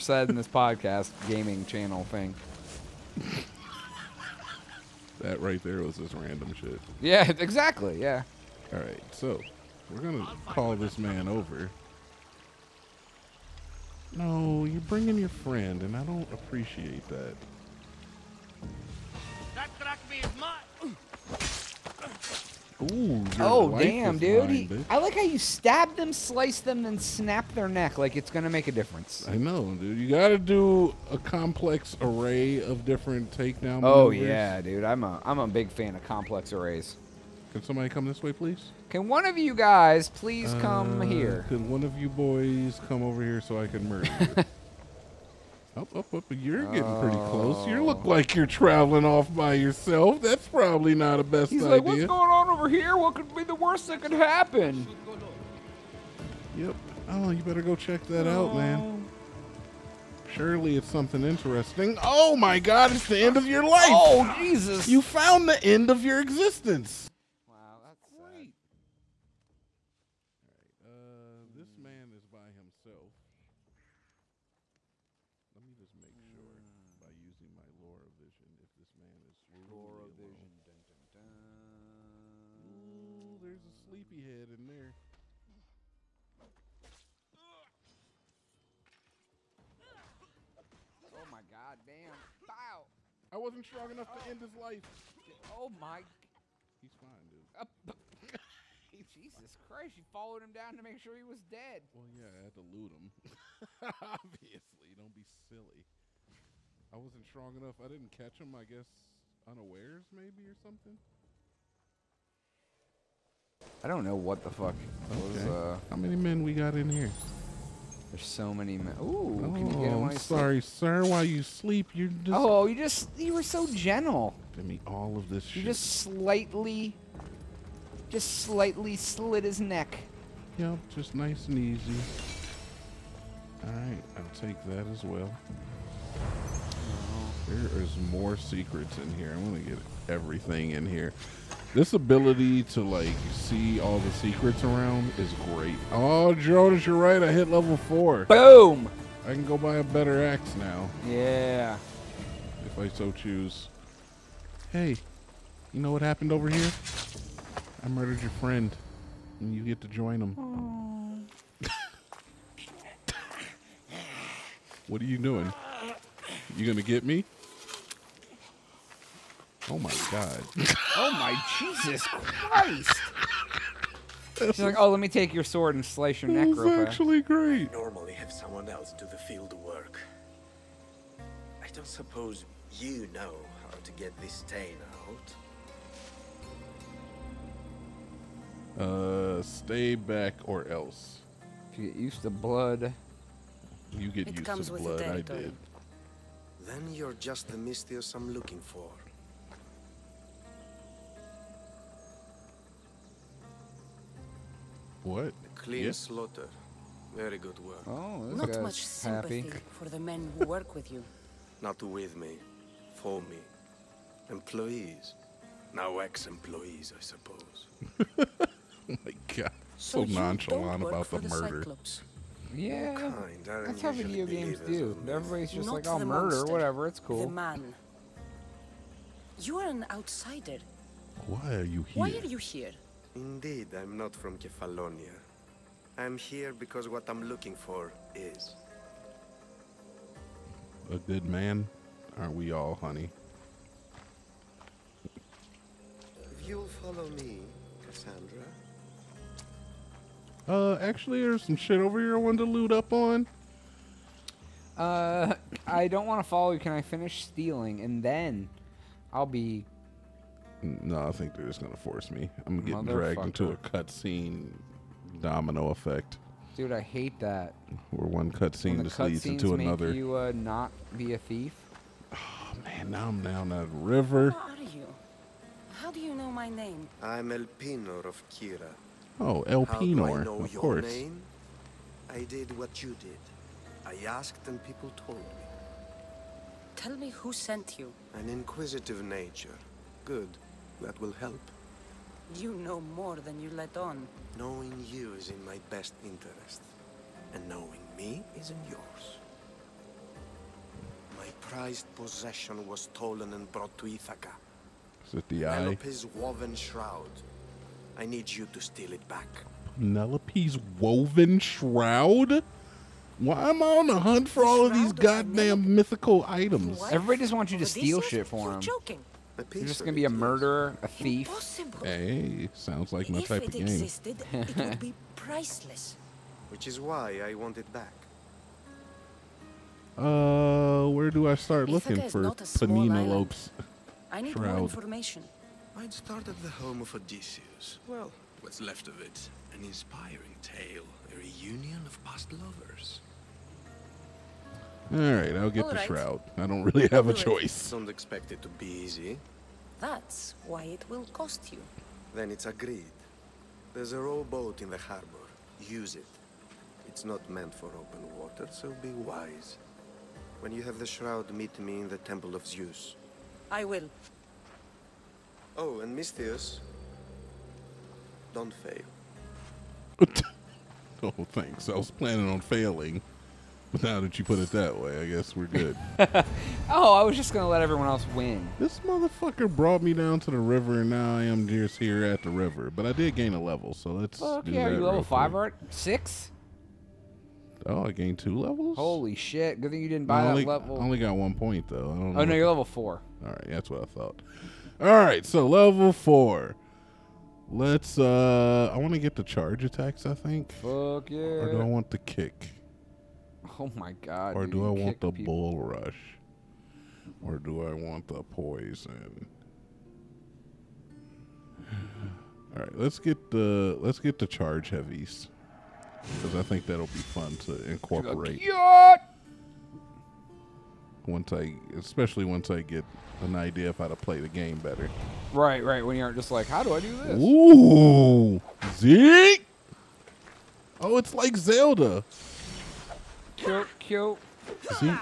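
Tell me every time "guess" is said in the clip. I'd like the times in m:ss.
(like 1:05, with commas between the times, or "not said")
1:48, 6:15.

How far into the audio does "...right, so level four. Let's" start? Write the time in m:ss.
6:34.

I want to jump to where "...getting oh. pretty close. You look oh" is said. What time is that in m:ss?
0:46.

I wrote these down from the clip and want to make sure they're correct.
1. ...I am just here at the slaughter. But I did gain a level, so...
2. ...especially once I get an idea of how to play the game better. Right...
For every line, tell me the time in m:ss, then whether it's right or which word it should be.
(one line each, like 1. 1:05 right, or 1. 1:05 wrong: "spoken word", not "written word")
1. 6:21 wrong: "river", not "slaughter"
2. 7:01 right.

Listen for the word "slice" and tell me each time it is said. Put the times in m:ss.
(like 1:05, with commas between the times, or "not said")
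0:26, 2:55.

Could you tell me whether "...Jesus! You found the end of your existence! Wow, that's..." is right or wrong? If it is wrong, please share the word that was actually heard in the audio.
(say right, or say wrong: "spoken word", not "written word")
right.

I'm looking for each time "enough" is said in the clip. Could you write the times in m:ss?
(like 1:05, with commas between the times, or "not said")
1:33, 1:47.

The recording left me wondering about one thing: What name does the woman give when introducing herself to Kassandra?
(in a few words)
Elpenor of Kirrha.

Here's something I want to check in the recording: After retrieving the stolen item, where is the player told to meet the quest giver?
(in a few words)
Temple of Zeus.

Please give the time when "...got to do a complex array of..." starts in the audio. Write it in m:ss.
0:30.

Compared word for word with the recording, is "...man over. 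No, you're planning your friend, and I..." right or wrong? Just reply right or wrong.
wrong.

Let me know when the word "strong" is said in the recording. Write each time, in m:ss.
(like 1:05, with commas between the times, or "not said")
1:33, 1:47.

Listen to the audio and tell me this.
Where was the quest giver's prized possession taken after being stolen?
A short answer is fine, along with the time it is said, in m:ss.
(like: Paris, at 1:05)
Ithaca, at 5:03.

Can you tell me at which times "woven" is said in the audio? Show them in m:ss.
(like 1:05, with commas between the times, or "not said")
5:06, 5:10.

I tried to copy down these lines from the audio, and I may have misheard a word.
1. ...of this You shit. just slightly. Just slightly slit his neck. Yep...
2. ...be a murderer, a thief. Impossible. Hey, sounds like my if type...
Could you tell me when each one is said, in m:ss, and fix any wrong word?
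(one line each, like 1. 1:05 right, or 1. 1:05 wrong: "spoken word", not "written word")
1. 2:05 right
2. 5:19 right.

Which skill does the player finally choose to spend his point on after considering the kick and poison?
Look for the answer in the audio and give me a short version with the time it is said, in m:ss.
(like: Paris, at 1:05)
charge heavies, at 6:54.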